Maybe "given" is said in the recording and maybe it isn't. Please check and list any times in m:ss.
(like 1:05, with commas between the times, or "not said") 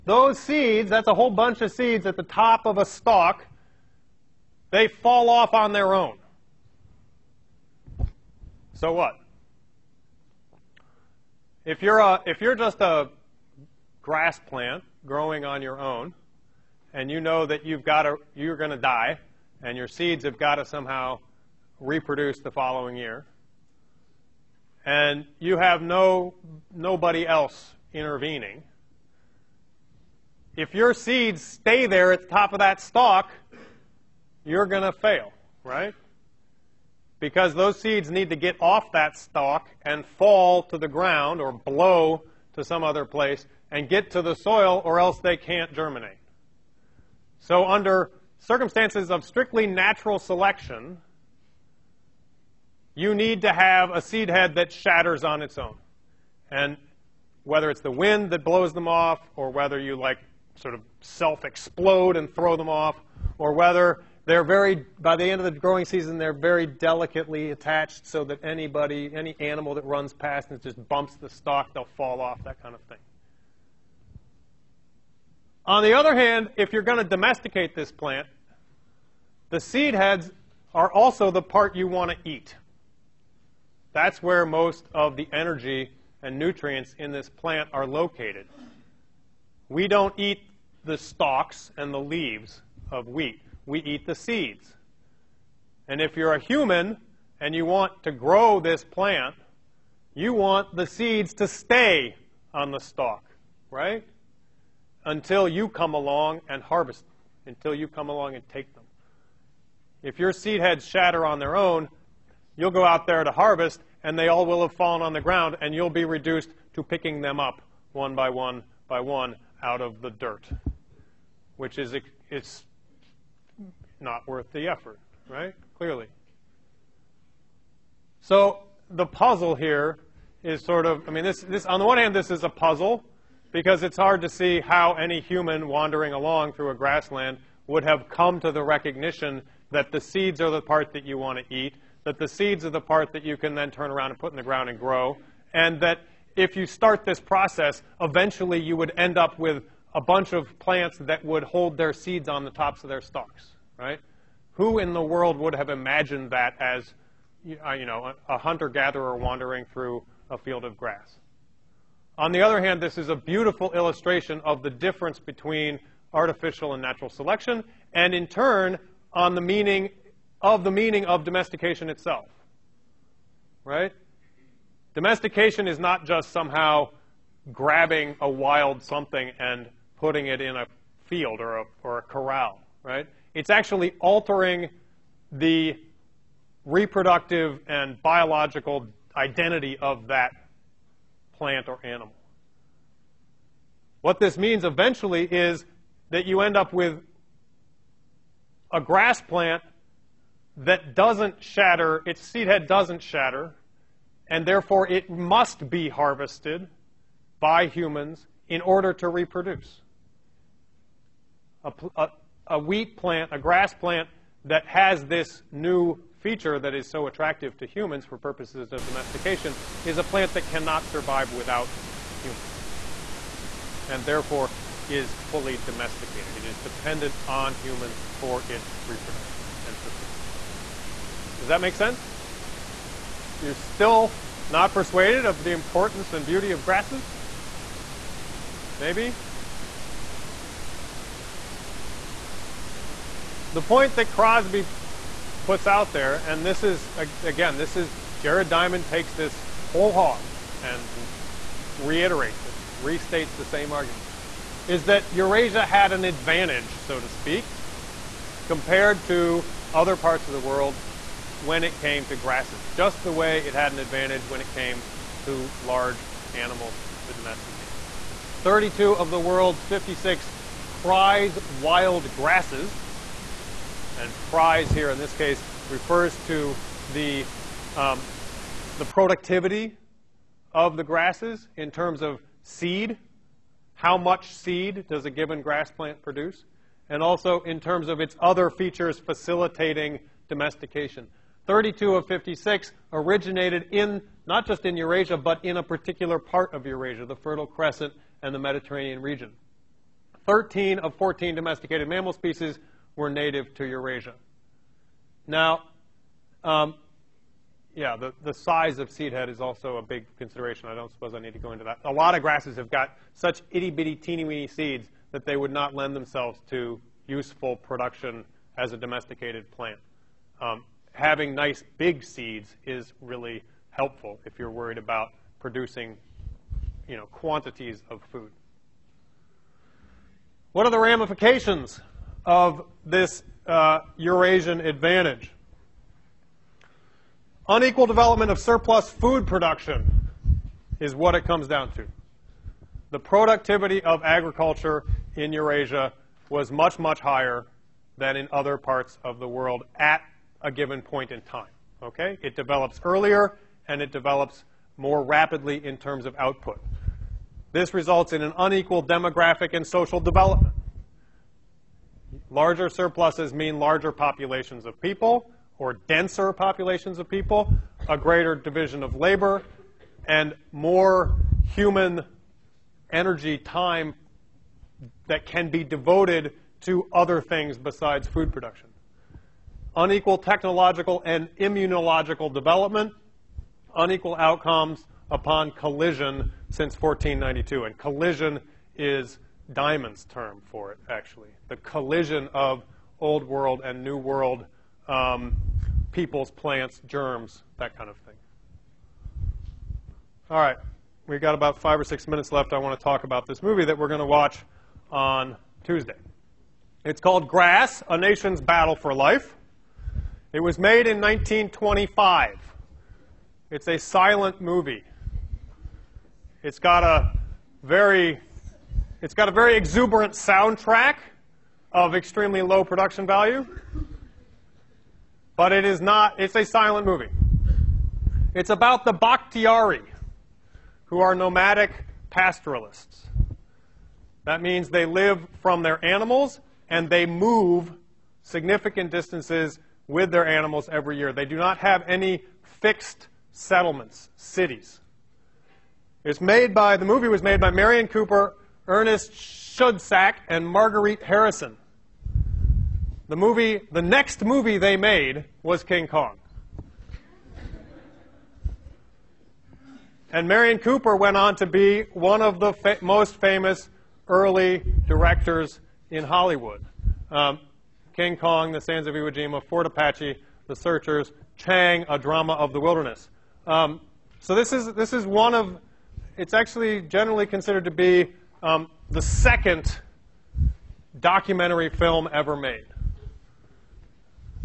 4:45, 5:50.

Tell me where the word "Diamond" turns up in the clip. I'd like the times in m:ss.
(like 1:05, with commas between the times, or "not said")
4:08, 6:29.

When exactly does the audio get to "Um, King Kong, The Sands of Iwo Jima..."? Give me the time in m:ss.
7:47.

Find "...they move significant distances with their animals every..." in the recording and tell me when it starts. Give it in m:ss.
7:16.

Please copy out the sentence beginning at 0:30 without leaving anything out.
If your seeds stay there at the top of that stalk, you're going to fail, right?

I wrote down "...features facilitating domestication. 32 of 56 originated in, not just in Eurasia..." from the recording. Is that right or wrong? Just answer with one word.
right.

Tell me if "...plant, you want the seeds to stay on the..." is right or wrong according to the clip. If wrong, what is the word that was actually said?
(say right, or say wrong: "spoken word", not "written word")
right.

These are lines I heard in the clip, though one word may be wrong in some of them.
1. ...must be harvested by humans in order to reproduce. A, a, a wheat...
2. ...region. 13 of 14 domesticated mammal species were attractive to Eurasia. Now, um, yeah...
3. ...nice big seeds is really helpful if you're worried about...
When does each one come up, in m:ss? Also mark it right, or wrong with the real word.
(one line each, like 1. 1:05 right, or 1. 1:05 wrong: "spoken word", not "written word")
1. 3:25 right
2. 4:59 wrong: "native", not "attractive"
3. 5:21 right.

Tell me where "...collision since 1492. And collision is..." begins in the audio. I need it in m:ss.
6:25.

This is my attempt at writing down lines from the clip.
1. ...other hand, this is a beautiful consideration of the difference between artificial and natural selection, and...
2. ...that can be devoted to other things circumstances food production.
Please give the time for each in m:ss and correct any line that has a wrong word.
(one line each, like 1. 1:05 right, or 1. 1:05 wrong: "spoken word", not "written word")
1. 2:42 wrong: "illustration", not "consideration"
2. 6:15 wrong: "besides", not "circumstances".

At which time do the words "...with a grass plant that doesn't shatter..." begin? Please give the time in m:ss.
3:16.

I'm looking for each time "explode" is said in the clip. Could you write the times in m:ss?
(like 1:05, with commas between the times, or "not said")
1:01.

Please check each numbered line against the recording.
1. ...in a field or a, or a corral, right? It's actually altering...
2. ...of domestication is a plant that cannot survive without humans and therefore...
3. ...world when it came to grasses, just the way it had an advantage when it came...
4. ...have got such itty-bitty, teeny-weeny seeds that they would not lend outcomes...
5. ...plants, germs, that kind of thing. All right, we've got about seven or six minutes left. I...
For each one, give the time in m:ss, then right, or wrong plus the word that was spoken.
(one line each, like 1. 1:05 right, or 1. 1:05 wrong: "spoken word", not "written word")
1. 3:00 right
2. 3:38 right
3. 4:20 right
4. 5:12 wrong: "themselves", not "outcomes"
5. 6:36 wrong: "five", not "seven".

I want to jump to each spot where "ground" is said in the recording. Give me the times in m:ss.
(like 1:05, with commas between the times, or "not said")
0:40, 1:55, 2:24.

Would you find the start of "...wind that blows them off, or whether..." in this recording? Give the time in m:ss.
0:57.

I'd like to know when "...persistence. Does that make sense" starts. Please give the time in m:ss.
3:49.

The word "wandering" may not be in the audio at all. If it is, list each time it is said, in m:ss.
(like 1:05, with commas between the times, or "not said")
2:15, 2:39.